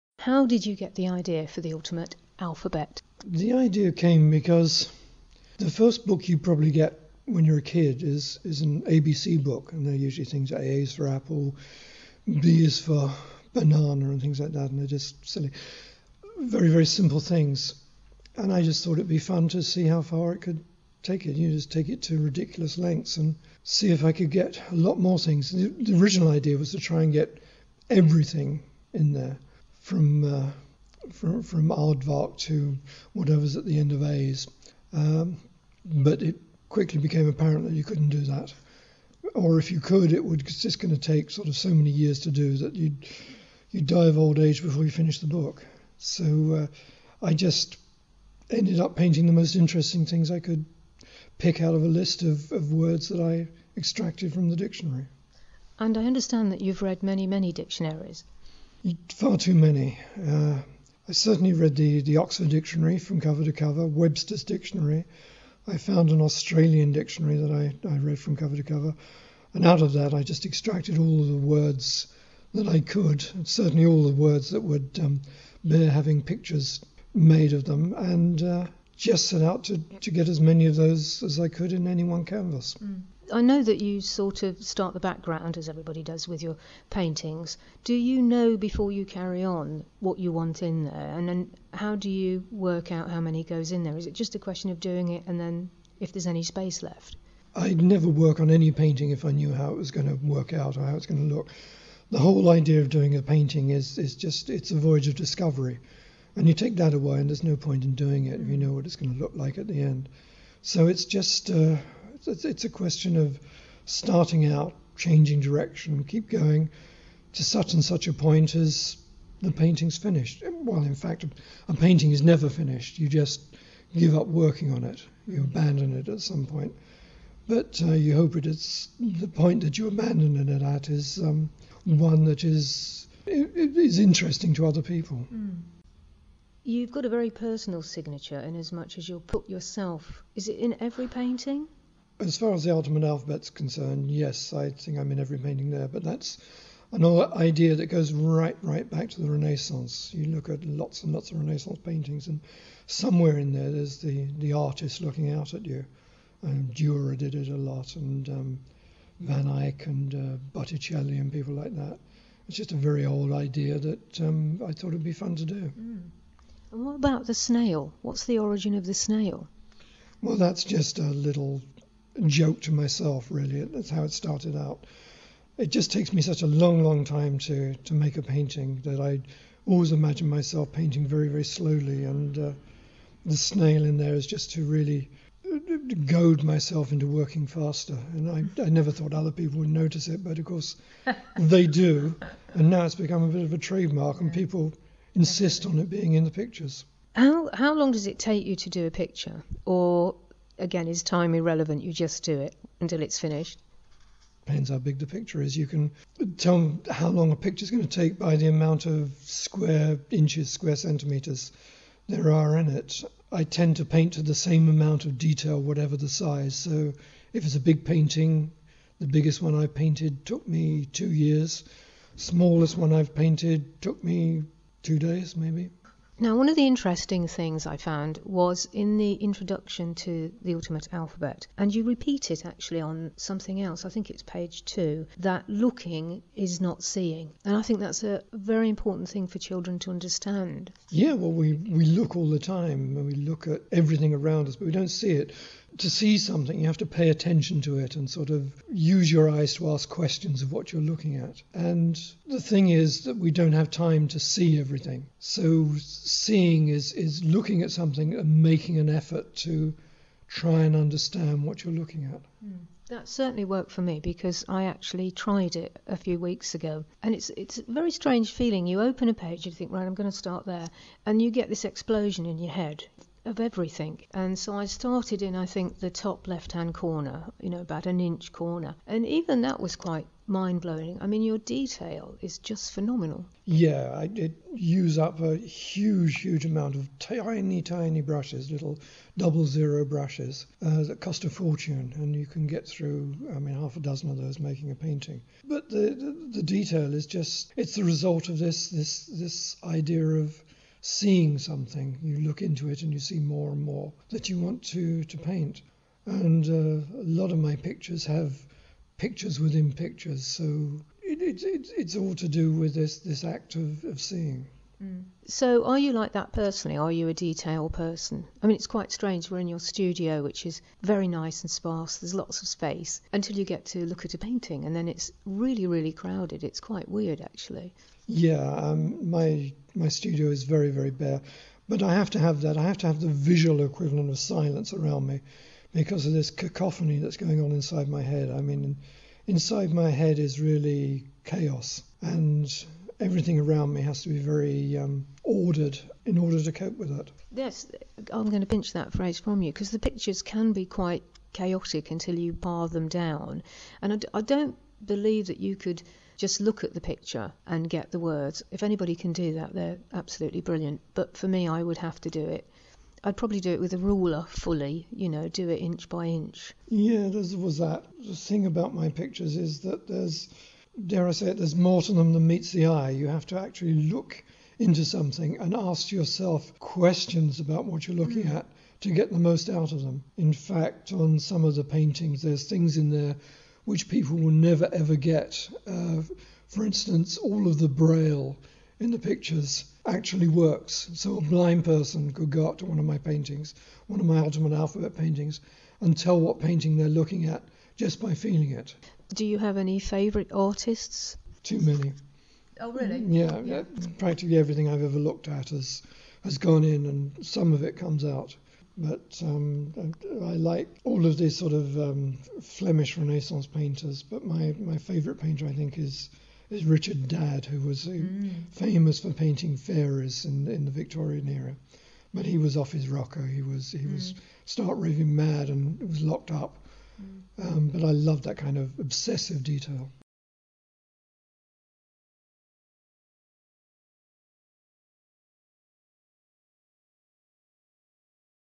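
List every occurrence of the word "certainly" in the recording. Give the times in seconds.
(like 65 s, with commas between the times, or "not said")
61 s, 73 s, 263 s.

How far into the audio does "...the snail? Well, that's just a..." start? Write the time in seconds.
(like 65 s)
168 s.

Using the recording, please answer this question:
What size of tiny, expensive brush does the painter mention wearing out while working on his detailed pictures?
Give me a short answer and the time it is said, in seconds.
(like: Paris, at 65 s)
Double zero, at 289 s.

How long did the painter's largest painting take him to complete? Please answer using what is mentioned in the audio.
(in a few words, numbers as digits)
2 years.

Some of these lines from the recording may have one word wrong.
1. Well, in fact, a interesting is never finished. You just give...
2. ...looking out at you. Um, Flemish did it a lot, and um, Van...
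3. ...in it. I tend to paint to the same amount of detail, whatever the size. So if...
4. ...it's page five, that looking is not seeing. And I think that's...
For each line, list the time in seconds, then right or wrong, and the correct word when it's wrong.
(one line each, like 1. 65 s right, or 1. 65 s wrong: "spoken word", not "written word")
1. 120 s wrong: "painting", not "interesting"
2. 155 s wrong: "Durer", not "Flemish"
3. 212 s right
4. 234 s wrong: "two", not "five".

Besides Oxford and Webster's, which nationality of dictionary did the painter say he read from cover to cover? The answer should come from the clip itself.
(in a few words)
Australian.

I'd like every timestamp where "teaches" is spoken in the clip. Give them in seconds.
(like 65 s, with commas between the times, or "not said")
not said.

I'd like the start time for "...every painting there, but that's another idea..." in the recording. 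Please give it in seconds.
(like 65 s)
145 s.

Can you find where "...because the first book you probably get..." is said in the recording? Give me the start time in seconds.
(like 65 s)
4 s.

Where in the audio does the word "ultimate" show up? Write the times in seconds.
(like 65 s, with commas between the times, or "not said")
1 s, 230 s, 394 s.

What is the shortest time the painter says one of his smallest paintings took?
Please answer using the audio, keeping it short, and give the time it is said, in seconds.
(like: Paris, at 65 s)
2 days, at 224 s.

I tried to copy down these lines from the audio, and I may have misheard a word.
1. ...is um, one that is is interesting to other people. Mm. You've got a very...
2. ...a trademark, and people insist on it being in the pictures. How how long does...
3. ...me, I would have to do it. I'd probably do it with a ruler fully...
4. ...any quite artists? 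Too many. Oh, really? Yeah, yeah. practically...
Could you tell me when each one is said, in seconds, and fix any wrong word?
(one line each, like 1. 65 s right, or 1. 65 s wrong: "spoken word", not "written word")
1. 130 s right
2. 193 s right
3. 361 s right
4. 399 s wrong: "favourite", not "quite".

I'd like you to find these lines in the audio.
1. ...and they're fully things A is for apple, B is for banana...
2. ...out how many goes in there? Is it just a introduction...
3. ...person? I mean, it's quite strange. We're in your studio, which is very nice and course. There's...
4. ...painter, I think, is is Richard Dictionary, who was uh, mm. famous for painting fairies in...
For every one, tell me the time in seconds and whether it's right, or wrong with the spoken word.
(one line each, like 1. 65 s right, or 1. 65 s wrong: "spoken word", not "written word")
1. 9 s wrong: "usually", not "fully"
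2. 92 s wrong: "question", not "introduction"
3. 317 s wrong: "sparse", not "course"
4. 415 s wrong: "Dadd", not "Dictionary".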